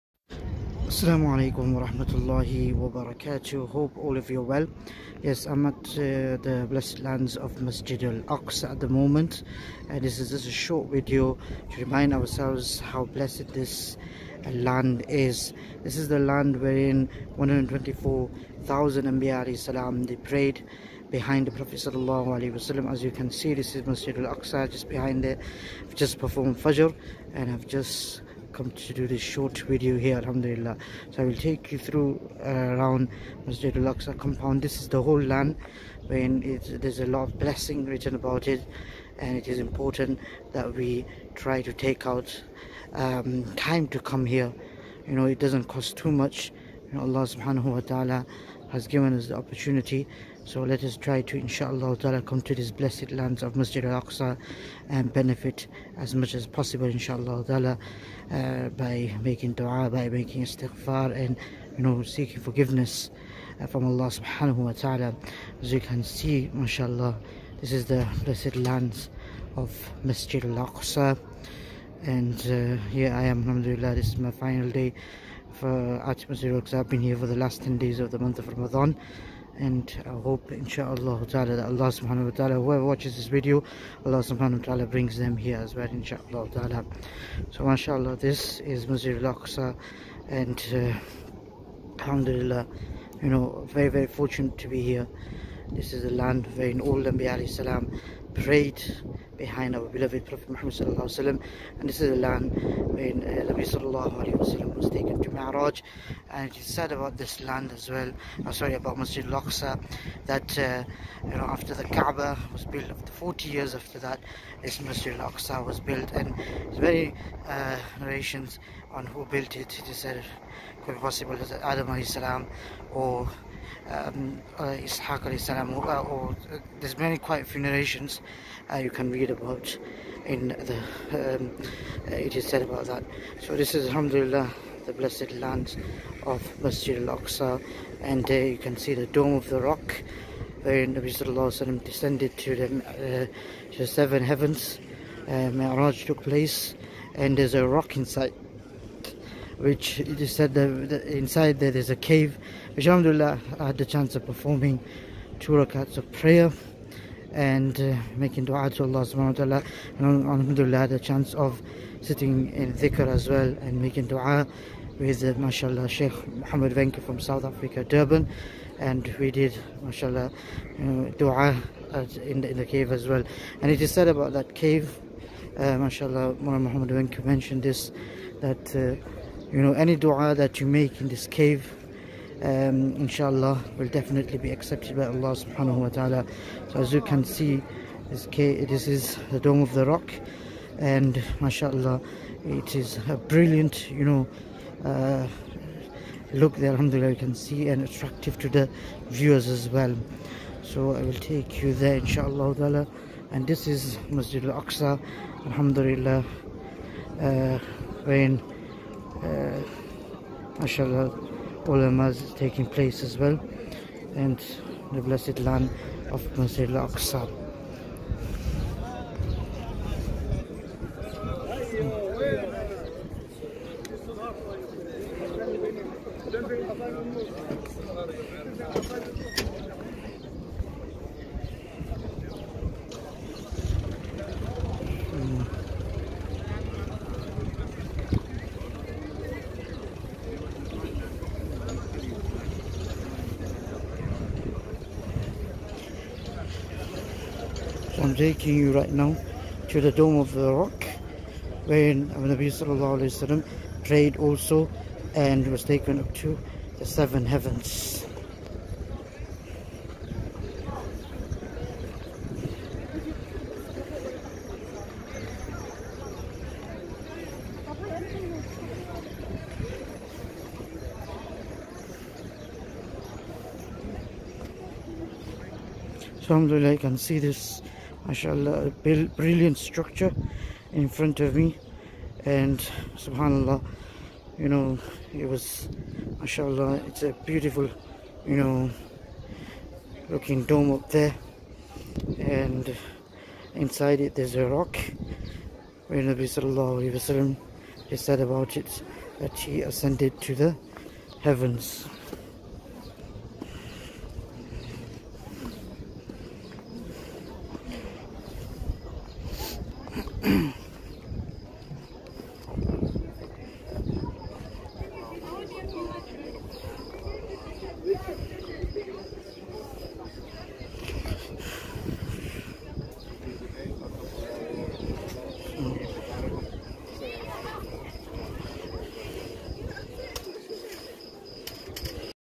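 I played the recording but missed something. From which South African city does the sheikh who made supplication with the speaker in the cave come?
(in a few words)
Durban.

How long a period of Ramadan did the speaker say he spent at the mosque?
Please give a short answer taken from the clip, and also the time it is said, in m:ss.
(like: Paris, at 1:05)
Last 10 days, at 1:17.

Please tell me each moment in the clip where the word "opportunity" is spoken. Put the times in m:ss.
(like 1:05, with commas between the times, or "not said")
0:49.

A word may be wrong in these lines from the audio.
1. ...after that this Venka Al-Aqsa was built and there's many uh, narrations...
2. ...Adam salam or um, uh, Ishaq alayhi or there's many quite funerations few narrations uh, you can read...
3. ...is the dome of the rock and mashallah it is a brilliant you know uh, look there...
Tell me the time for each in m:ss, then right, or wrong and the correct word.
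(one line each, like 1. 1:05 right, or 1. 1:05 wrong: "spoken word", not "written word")
1. 1:53 wrong: "Masjid", not "Venka"
2. 2:01 right
3. 3:08 right.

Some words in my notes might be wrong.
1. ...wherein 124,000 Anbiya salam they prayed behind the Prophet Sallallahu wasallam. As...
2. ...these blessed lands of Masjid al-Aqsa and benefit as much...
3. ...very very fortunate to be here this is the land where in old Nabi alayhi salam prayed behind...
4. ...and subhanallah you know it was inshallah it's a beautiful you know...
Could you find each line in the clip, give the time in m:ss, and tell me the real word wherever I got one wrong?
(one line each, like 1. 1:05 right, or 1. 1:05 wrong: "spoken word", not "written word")
1. 0:16 right
2. 0:52 right
3. 1:33 right
4. 4:42 wrong: "mashallah", not "inshallah".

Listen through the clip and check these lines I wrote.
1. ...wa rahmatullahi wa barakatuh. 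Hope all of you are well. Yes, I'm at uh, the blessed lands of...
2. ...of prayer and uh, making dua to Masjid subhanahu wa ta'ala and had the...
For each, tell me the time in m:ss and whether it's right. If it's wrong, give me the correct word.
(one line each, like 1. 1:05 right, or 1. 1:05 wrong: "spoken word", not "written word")
1. 0:01 right
2. 2:35 wrong: "Allah", not "Masjid".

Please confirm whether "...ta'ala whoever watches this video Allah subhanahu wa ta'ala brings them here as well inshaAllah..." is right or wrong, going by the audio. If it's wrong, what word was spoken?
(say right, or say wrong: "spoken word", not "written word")
right.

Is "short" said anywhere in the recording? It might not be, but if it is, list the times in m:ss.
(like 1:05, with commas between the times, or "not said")
0:10, 0:29.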